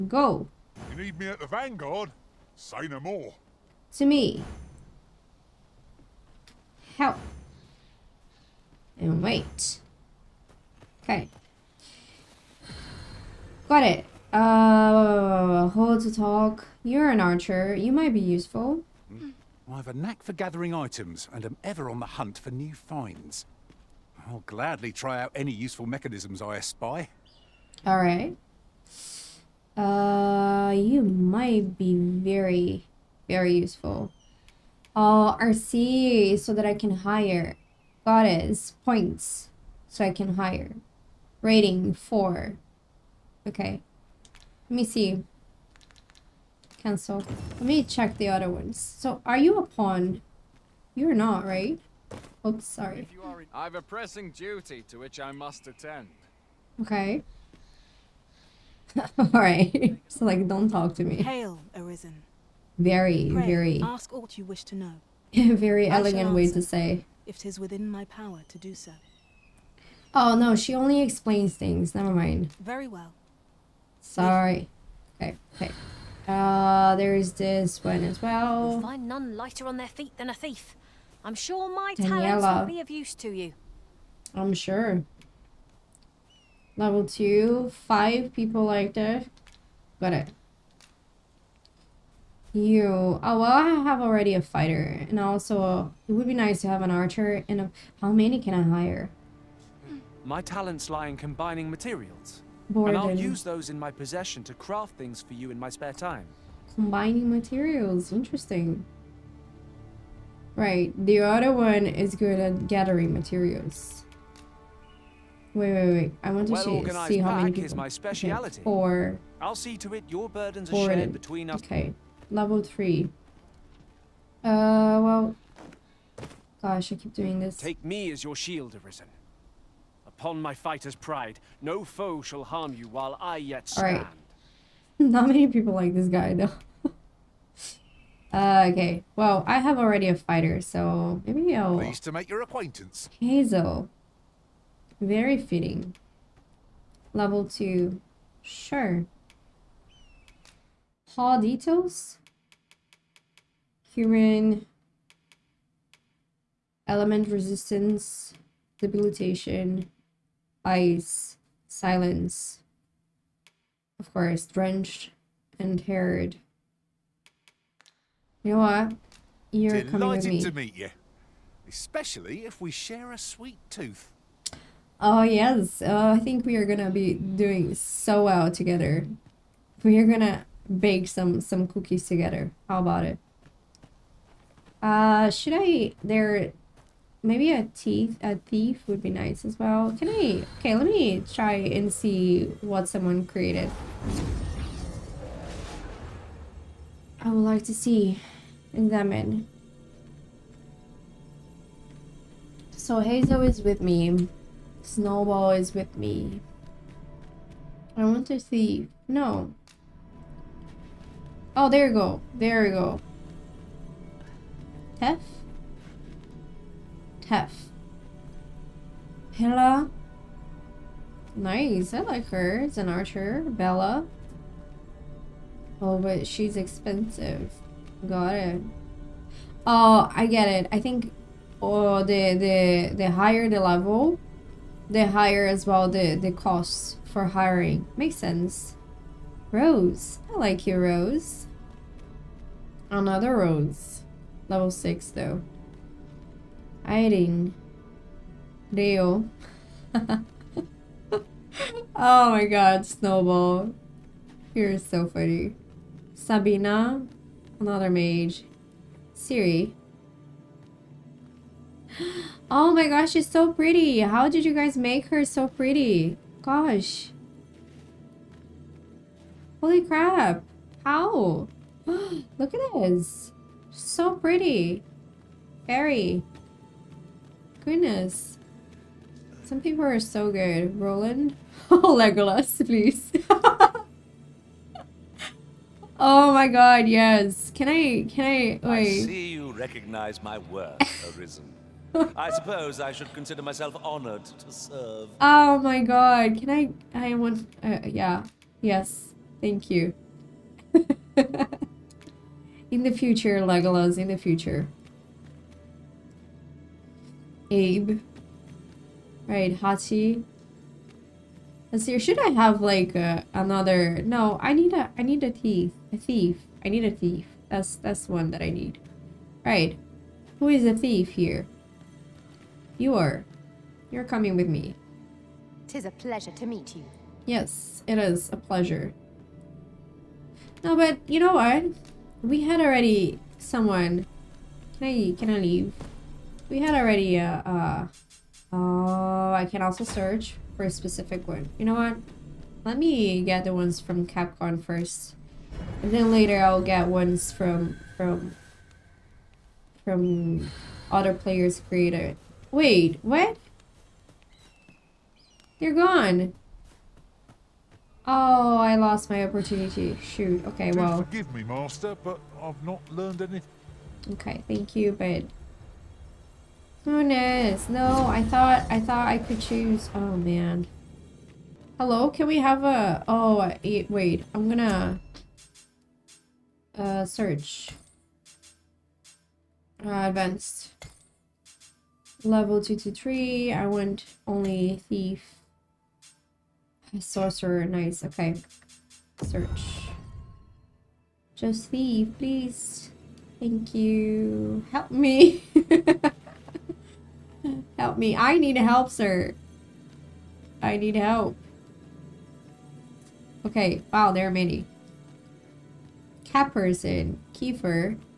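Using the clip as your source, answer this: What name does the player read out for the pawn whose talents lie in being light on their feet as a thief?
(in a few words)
Daniela.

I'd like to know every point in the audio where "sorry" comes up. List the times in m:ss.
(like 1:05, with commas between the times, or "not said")
0:52, 1:14.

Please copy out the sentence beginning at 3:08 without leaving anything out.
A thief would be nice as well.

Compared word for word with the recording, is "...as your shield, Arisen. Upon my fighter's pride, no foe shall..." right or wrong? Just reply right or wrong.
right.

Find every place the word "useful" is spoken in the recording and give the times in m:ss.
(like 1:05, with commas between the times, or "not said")
0:18, 0:25, 0:33.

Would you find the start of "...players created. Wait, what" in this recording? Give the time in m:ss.
5:51.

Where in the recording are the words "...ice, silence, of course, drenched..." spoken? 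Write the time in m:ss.
2:40.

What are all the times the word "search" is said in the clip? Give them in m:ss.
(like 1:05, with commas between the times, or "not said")
5:39, 6:17, 6:29.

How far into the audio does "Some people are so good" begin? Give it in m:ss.
4:39.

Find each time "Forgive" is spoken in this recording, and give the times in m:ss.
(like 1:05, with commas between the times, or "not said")
6:01.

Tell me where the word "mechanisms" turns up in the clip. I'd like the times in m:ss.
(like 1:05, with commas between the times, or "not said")
0:25.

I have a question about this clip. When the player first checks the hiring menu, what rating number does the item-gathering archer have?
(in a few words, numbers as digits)
4.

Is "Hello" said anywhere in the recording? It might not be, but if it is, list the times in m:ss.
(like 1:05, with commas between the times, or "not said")
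6:11.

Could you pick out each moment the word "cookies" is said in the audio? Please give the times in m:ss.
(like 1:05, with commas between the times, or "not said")
3:01.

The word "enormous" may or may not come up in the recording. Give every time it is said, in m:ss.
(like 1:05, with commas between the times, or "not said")
not said.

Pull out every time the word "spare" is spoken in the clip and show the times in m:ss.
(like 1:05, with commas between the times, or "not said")
1:45.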